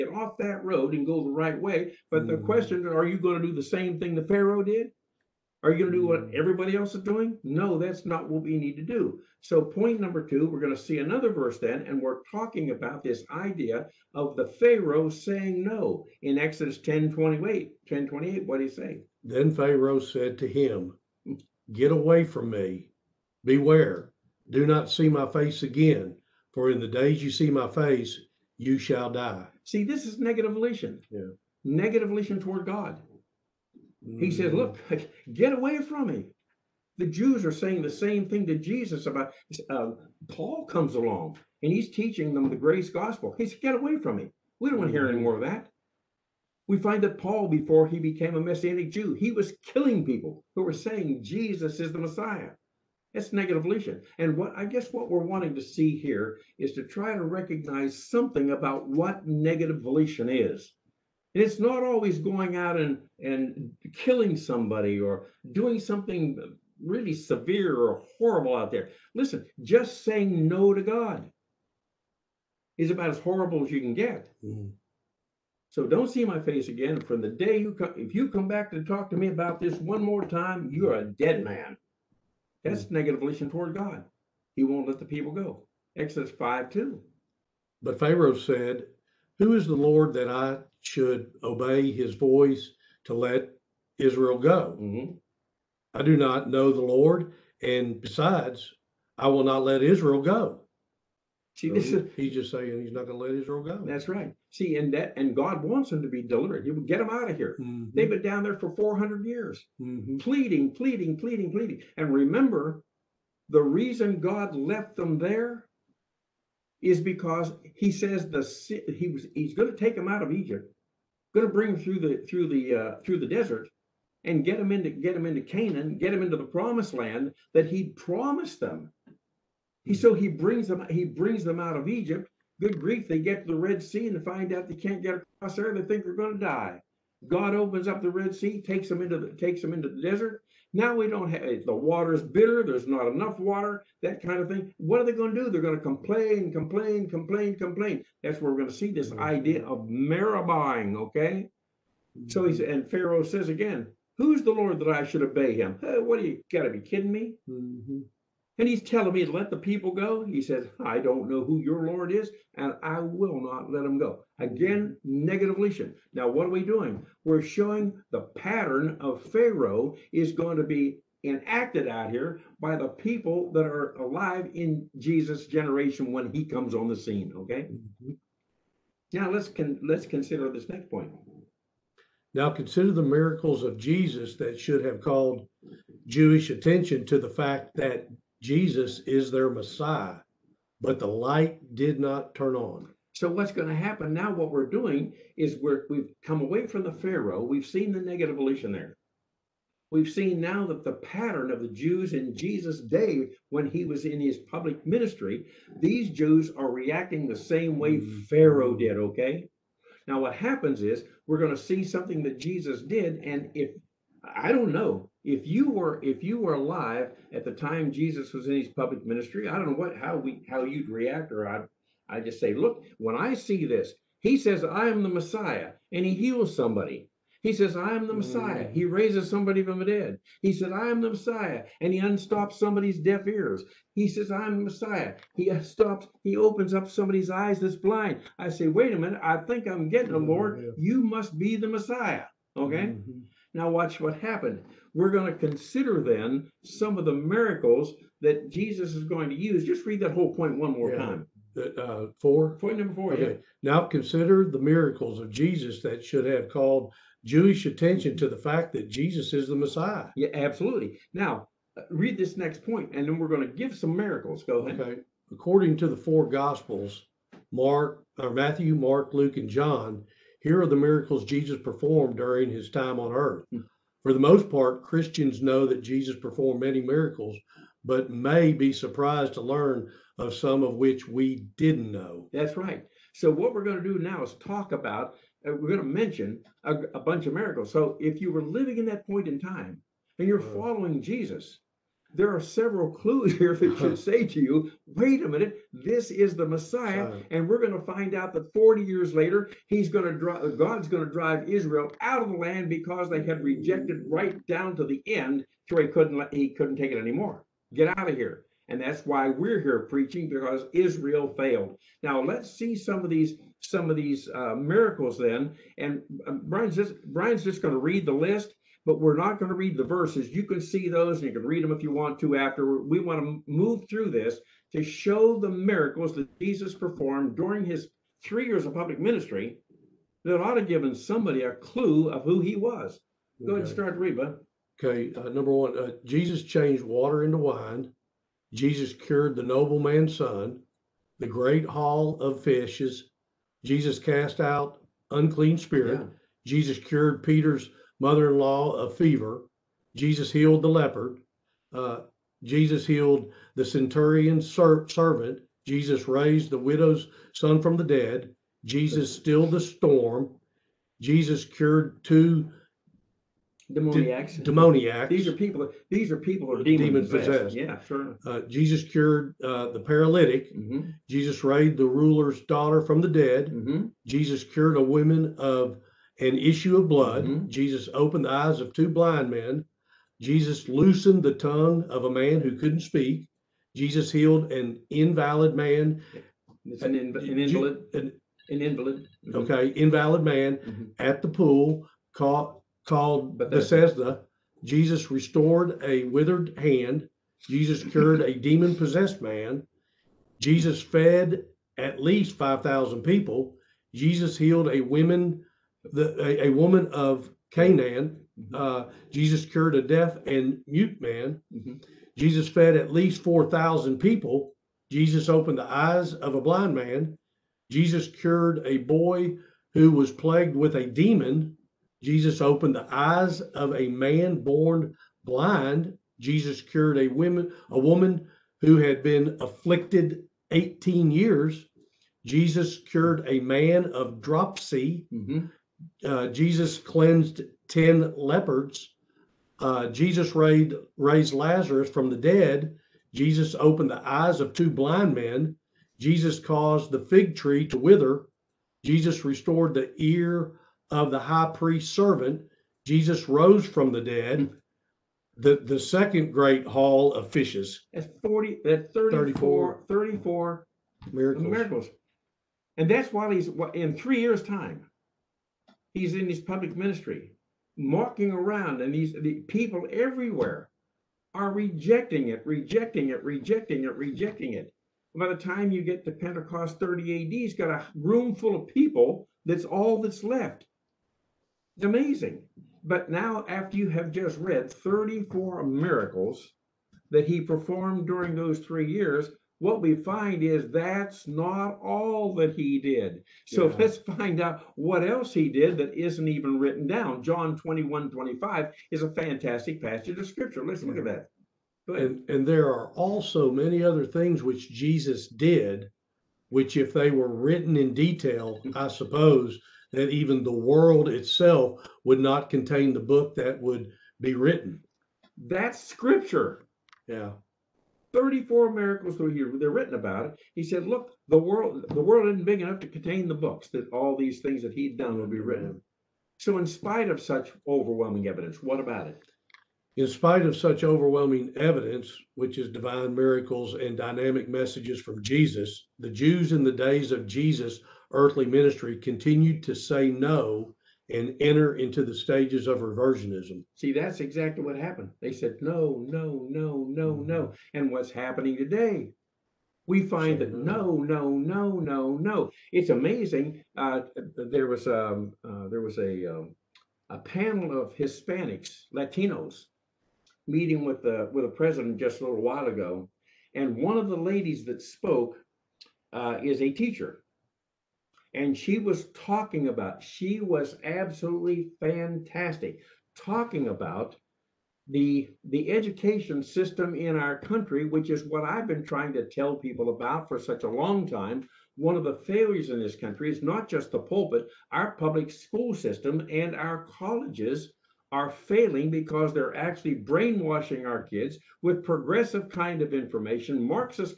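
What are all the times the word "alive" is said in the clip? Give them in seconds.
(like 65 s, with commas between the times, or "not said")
173 s, 216 s.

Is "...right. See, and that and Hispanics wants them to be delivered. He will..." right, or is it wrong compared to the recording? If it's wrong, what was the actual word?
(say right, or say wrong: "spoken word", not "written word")
wrong: "God", not "Hispanics".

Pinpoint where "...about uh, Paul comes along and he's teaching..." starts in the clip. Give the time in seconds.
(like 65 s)
39 s.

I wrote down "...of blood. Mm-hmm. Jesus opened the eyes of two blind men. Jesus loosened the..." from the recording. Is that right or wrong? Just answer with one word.
right.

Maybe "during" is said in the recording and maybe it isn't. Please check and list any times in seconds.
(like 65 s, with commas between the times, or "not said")
272 s, 327 s, 488 s.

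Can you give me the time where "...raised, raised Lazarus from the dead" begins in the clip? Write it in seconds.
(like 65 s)
440 s.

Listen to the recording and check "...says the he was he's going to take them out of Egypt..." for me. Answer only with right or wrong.
right.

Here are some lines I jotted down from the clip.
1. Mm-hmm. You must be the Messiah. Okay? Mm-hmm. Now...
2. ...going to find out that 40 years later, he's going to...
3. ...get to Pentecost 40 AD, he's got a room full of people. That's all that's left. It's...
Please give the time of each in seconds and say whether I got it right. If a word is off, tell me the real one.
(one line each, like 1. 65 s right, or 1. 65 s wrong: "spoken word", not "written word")
1. 240 s right
2. 297 s right
3. 475 s wrong: "30", not "40".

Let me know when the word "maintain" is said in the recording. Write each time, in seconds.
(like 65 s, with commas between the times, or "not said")
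not said.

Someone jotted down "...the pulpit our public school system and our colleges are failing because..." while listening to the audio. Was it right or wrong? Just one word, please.
right.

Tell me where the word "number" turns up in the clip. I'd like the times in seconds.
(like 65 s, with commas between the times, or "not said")
9 s, 252 s, 335 s.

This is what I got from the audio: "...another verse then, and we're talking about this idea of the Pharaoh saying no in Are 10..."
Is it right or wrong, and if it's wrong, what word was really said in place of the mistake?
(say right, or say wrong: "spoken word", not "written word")
wrong: "Exodus", not "Are".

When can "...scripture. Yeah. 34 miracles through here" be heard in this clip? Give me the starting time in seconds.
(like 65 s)
515 s.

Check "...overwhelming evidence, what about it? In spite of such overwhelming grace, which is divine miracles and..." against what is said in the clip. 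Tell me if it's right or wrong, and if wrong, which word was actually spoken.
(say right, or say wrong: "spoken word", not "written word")
wrong: "evidence", not "grace".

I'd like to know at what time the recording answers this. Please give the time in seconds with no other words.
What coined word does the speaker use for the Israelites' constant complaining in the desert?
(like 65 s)
149 s.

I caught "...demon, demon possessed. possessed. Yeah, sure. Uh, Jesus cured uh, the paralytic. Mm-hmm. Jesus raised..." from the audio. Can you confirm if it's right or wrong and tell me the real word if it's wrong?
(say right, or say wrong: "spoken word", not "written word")
right.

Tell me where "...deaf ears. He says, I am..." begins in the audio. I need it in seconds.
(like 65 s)
232 s.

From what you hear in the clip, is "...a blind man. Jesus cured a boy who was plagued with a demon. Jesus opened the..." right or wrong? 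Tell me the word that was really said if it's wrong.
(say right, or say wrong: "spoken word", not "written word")
right.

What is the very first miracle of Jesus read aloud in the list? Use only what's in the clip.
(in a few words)
Changed water into wine.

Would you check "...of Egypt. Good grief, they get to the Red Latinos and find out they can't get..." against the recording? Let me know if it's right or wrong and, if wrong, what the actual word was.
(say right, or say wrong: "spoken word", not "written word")
wrong: "Sea", not "Latinos".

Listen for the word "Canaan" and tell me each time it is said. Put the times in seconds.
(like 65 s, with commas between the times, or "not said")
125 s, 407 s.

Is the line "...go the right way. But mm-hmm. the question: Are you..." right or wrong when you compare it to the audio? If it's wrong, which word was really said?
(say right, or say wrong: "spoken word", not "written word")
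right.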